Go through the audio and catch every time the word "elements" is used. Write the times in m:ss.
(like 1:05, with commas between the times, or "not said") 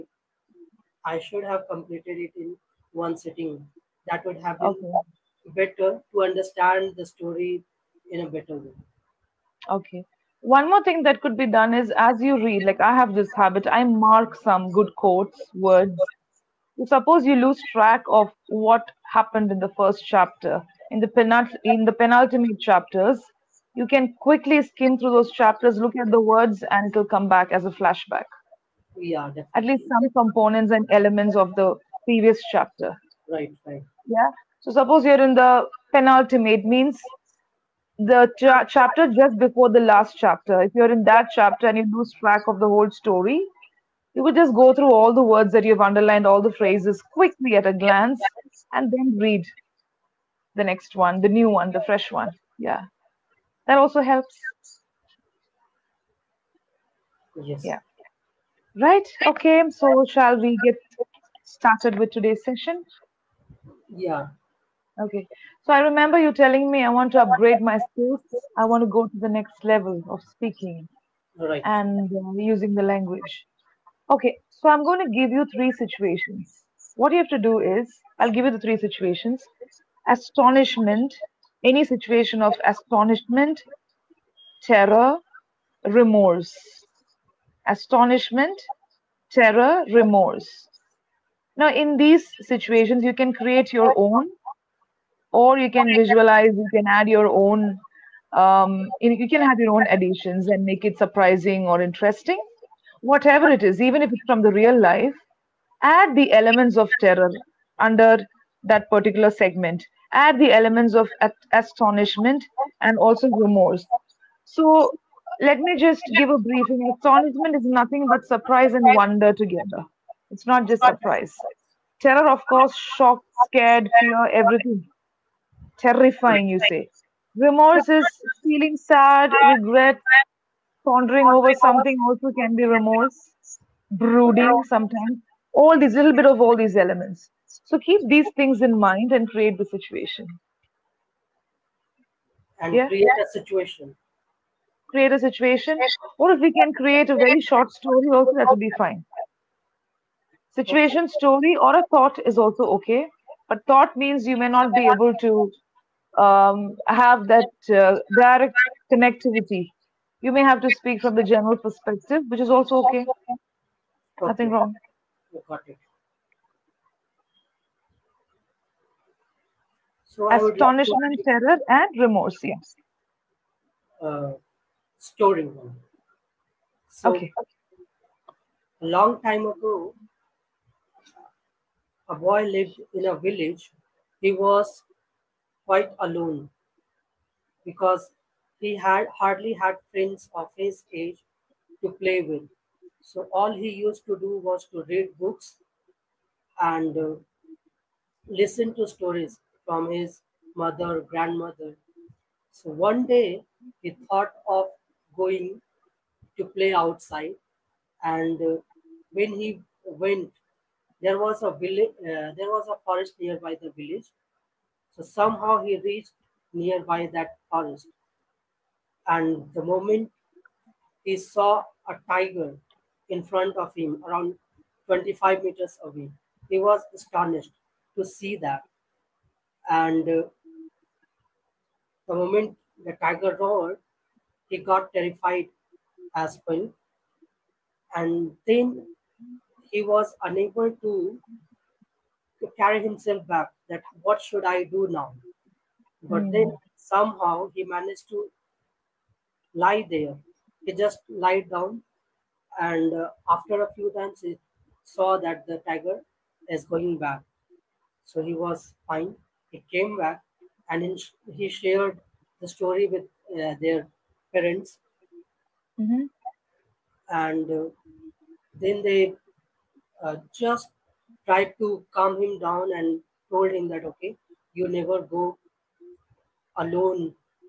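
0:30, 1:46, 1:50, 2:16.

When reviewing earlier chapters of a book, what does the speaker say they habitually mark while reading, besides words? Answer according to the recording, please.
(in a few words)
quotes.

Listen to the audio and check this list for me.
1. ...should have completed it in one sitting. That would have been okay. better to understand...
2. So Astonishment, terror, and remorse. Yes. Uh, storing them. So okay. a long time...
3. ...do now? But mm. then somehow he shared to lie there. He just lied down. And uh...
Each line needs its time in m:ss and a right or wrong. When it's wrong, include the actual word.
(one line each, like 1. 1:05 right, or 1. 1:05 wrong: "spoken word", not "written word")
1. 0:01 right
2. 2:50 right
3. 4:04 wrong: "managed", not "shared".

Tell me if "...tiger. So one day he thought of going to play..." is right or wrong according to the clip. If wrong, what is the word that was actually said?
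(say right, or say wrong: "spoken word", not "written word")
wrong: "grandmother", not "tiger".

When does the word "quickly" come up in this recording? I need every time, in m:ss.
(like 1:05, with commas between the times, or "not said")
0:24, 0:47.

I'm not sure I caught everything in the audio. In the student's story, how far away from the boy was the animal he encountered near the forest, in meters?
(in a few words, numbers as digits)
25.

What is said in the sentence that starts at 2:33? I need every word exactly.
But thought means you may not be able to um, have that uh, direct connectivity.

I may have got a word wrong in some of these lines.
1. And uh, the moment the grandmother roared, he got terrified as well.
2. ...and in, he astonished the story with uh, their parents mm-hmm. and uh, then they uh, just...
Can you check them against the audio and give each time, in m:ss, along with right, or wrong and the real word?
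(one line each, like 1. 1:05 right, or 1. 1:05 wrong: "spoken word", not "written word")
1. 3:49 wrong: "tiger", not "grandmother"
2. 4:20 wrong: "shared", not "astonished".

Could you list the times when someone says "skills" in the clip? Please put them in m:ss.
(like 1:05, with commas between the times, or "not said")
1:07.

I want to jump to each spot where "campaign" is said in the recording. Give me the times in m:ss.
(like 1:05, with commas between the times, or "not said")
not said.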